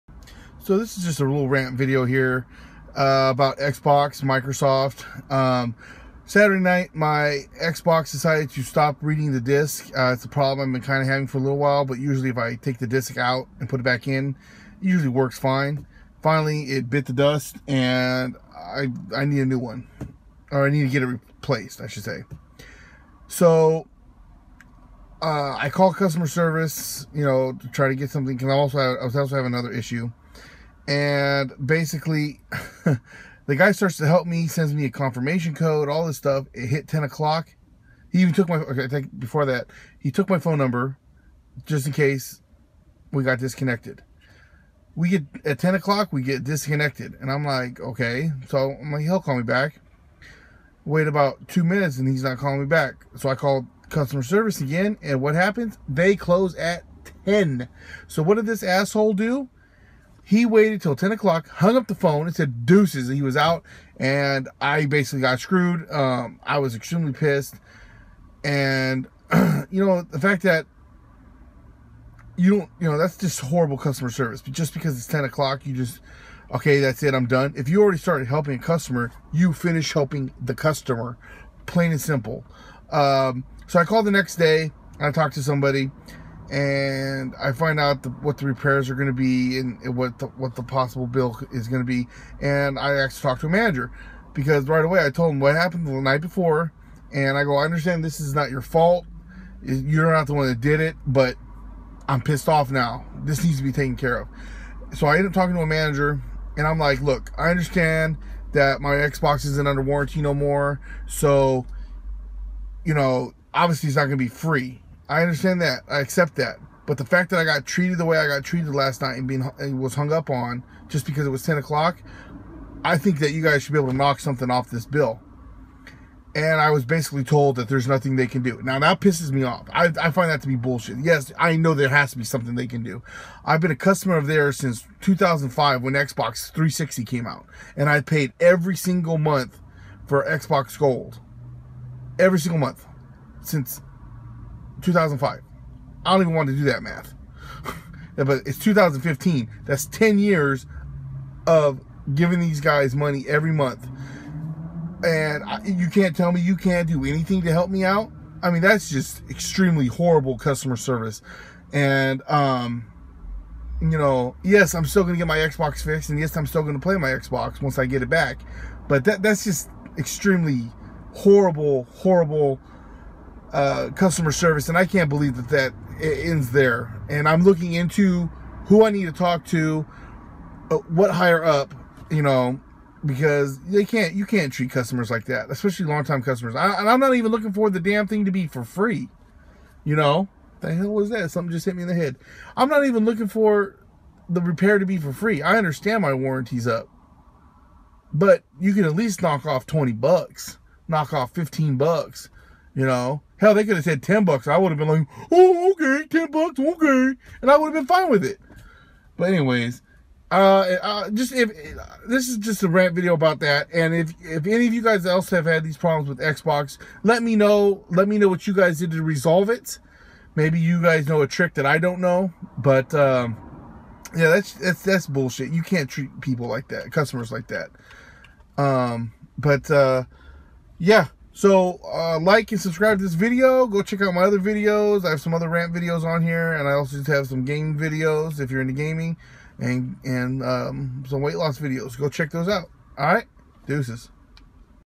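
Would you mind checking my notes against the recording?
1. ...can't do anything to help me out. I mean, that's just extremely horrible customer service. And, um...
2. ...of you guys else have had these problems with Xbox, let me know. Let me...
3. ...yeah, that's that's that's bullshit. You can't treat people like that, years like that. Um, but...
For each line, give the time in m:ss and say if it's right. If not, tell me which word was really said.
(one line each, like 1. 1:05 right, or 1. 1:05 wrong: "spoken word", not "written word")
1. 2:36 right
2. 3:34 right
3. 3:44 wrong: "customers", not "years".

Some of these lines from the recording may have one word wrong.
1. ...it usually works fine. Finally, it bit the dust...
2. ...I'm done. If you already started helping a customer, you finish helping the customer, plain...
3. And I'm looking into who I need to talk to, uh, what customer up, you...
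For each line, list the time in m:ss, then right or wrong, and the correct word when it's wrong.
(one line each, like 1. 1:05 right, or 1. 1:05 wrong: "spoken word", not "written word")
1. 0:14 right
2. 1:17 right
3. 2:57 wrong: "higher", not "customer".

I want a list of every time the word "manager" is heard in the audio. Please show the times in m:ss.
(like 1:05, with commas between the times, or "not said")
1:33, 1:45.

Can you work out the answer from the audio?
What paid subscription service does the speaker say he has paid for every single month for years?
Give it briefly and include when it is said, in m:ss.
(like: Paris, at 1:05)
Xbox Gold, at 2:20.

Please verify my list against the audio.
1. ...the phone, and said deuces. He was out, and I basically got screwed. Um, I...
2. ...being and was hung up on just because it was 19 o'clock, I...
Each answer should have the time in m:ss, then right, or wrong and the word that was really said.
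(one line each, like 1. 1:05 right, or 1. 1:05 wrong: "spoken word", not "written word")
1. 1:01 right
2. 1:59 wrong: "10", not "19".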